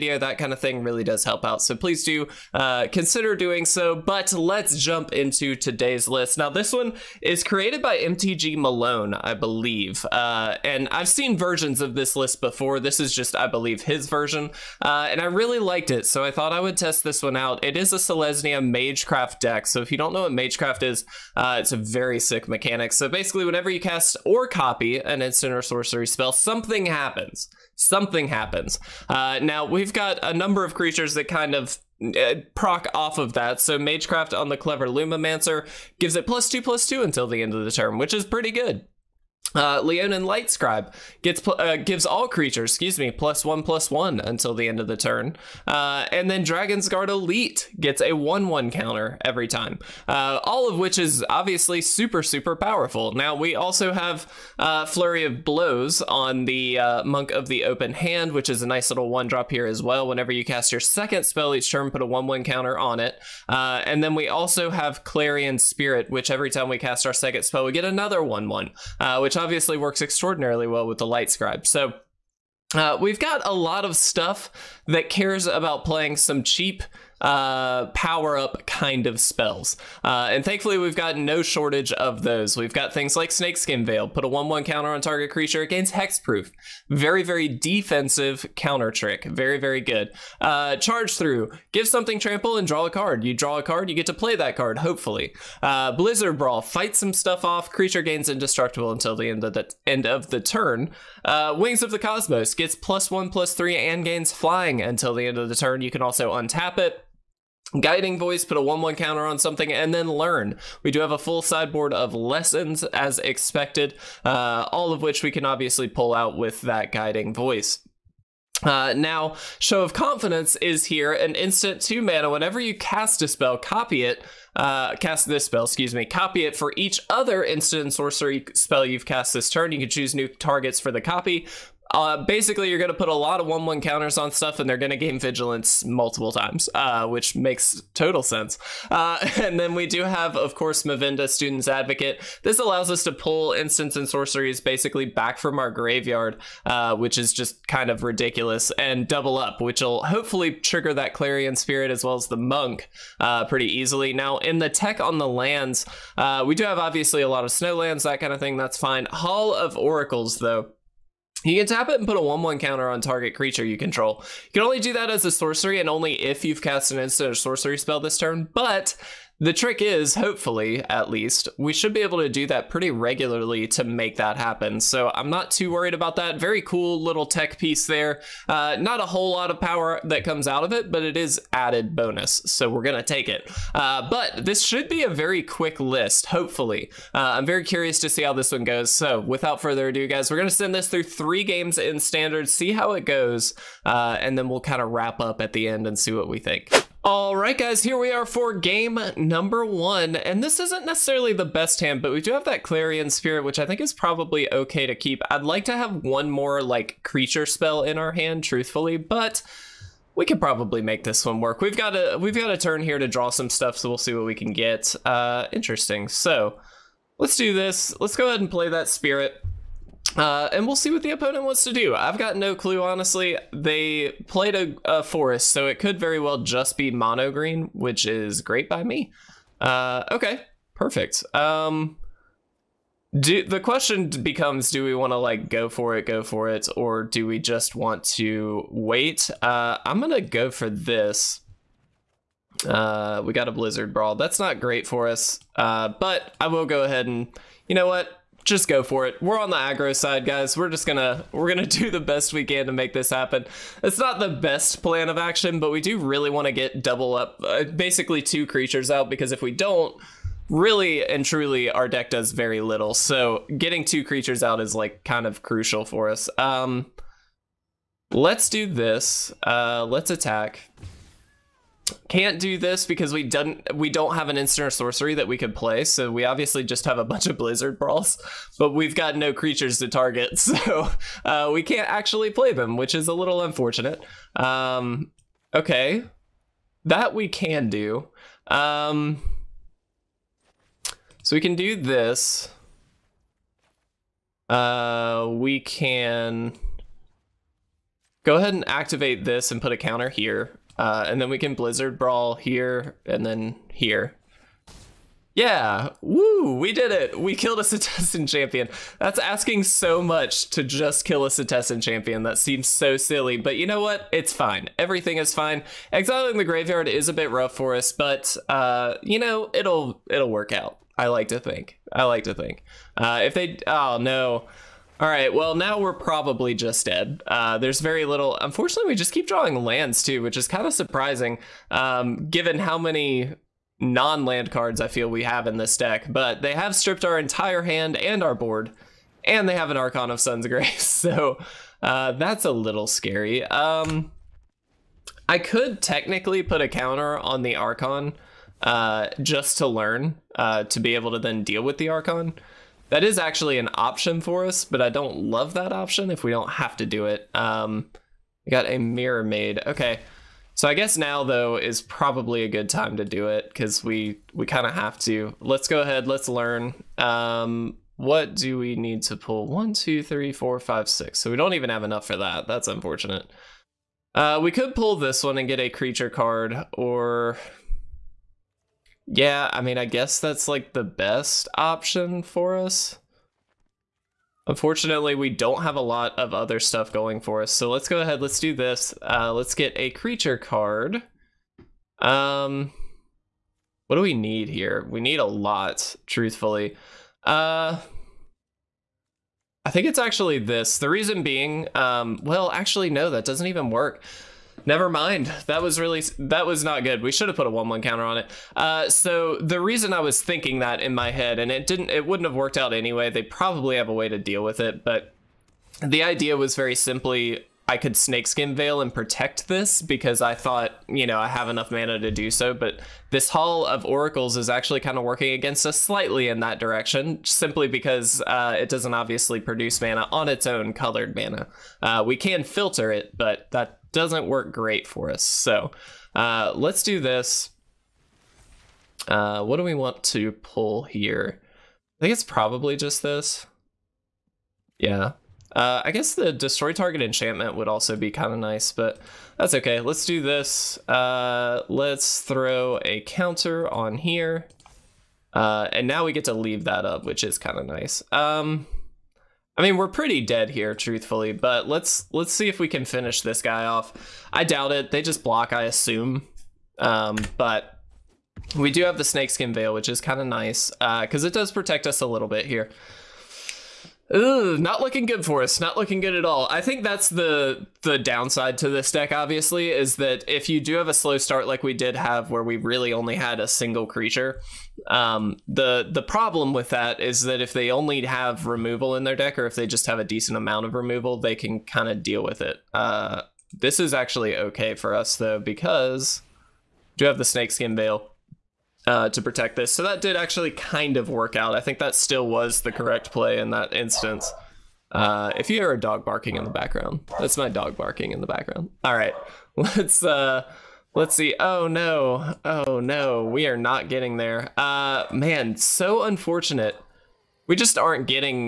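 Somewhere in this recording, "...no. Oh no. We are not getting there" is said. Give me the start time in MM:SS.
08:31.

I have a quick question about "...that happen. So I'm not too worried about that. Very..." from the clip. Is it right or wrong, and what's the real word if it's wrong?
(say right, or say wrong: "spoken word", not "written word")
right.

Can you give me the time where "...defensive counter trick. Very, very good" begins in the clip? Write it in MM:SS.
01:27.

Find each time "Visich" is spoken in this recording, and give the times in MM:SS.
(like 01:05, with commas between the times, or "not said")
not said.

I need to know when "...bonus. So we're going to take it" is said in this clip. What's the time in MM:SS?
03:01.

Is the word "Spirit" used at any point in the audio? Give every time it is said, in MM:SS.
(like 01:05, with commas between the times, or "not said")
01:05, 02:31, 03:23, 03:38.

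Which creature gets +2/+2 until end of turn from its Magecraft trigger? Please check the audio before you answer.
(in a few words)
Clever Lumimancer.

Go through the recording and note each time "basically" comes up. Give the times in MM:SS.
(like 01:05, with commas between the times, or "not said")
00:23, 02:12, 02:24, 04:17.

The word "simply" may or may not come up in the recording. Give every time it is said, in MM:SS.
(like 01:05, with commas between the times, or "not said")
06:56, 07:07.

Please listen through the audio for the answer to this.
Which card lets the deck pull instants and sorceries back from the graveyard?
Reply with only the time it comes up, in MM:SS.
02:20.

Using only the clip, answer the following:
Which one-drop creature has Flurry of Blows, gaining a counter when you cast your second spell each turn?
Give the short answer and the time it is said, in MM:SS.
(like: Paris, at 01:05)
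Monk of the Open Hand, at 00:57.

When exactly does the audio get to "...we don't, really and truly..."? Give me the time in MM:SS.
04:19.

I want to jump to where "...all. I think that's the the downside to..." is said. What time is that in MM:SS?
07:56.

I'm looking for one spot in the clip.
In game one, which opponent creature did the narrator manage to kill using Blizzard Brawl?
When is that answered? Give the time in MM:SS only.
05:11.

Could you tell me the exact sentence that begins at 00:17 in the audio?
It is a Selesnya Magecraft deck.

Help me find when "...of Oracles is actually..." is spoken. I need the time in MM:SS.
07:03.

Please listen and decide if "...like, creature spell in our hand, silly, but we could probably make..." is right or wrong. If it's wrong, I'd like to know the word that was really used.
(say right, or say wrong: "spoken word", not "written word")
wrong: "truthfully", not "silly".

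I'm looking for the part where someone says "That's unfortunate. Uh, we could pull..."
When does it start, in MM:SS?
06:12.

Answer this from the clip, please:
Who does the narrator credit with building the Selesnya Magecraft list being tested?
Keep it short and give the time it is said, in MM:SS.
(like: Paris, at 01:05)
MTG Malone, at 00:07.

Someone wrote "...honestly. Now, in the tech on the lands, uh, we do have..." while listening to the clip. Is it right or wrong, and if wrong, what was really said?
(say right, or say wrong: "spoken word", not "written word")
wrong: "easily", not "honestly".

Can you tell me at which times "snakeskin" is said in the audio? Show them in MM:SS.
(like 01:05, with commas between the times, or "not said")
01:23, 06:57, 07:49, 08:17.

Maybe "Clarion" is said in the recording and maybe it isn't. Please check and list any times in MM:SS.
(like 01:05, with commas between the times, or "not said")
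01:05, 02:31, 03:22.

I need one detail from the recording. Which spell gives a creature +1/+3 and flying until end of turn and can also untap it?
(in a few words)
Wings of the Cosmos.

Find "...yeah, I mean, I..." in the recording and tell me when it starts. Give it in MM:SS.
06:19.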